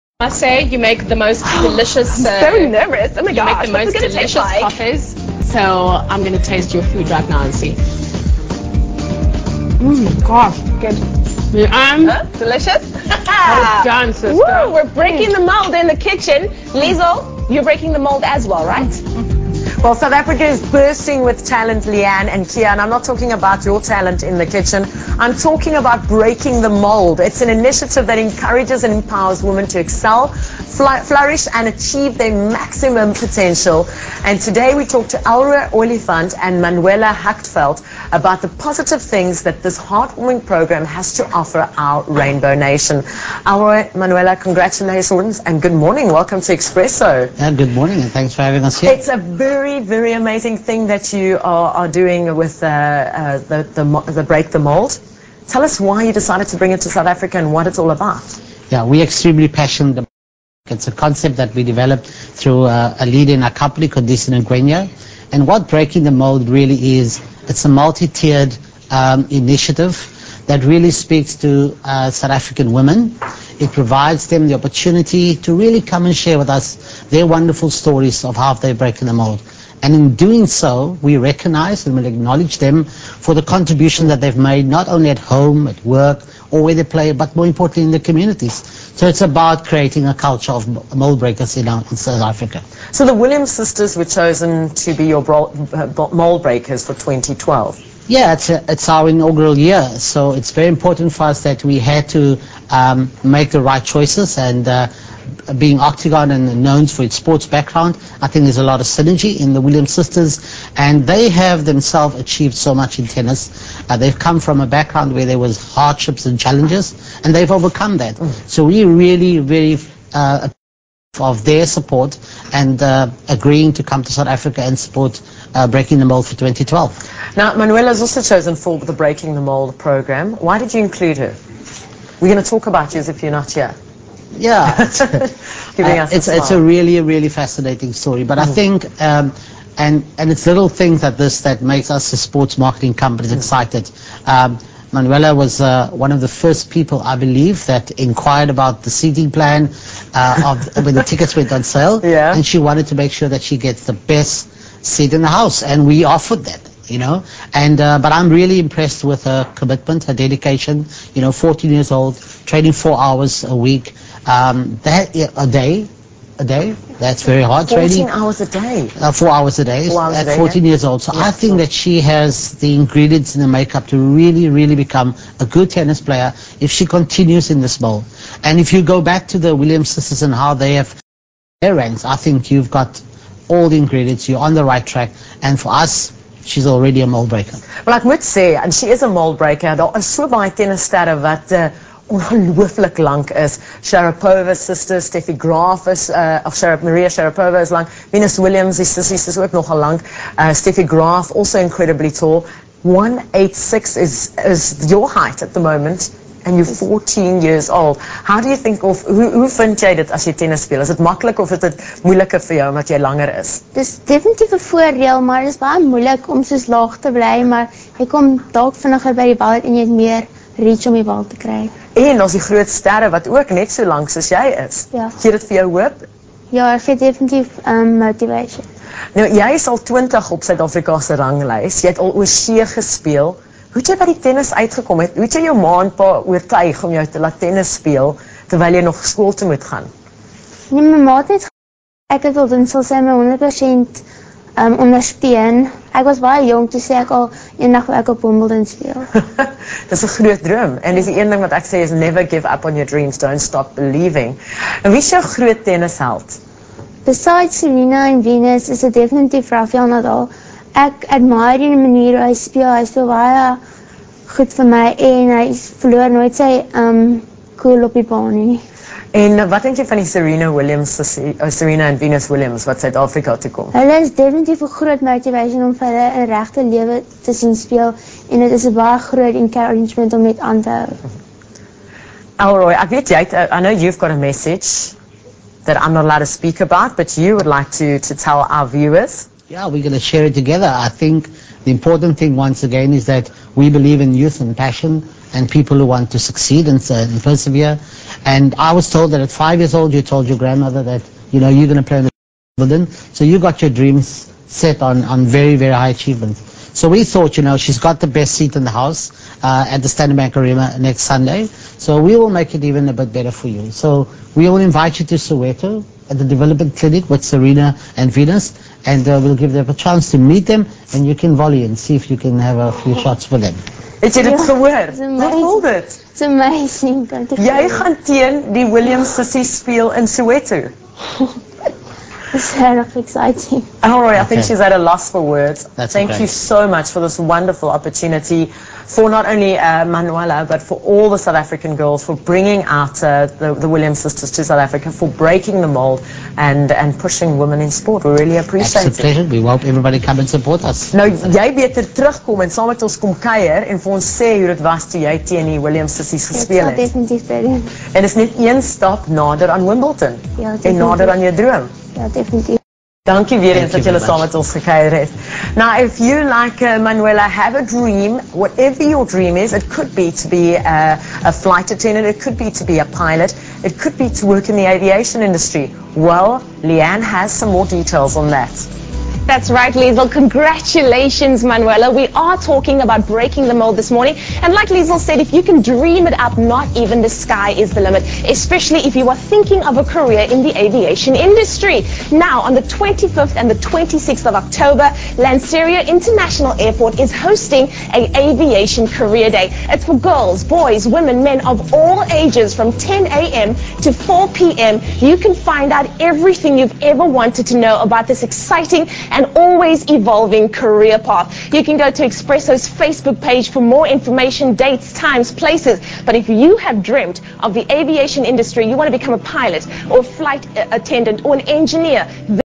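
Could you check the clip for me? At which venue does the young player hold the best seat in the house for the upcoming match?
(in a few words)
Standard Bank Arena.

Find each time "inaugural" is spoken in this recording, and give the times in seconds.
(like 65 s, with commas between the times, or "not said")
99 s.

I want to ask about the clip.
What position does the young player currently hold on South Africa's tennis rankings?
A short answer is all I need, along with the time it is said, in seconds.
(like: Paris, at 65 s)
20, at 229 s.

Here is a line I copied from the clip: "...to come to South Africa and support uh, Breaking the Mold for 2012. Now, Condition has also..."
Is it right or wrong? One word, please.
wrong.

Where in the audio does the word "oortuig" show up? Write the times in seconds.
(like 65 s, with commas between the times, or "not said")
236 s.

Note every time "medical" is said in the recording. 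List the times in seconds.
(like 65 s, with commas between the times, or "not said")
not said.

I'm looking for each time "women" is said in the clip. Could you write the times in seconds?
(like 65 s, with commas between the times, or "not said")
29 s, 72 s, 347 s, 400 s.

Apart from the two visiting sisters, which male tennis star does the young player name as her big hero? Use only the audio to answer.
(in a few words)
Rafael Nadal.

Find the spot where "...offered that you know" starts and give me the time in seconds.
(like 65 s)
156 s.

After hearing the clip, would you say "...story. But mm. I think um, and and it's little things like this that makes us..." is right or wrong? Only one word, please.
right.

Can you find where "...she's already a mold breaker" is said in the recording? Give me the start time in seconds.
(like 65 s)
186 s.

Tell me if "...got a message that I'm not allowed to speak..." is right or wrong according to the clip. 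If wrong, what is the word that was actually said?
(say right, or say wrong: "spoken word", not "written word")
right.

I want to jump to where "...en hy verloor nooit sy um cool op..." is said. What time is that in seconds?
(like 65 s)
265 s.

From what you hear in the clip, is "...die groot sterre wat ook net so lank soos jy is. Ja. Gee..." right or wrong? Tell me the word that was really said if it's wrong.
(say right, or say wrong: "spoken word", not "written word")
right.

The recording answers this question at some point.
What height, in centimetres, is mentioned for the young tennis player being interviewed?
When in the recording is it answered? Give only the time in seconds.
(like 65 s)
202 s.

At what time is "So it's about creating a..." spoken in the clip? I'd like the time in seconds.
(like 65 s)
88 s.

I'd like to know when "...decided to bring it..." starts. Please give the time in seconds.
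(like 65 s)
56 s.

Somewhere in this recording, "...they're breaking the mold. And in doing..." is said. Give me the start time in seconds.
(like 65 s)
78 s.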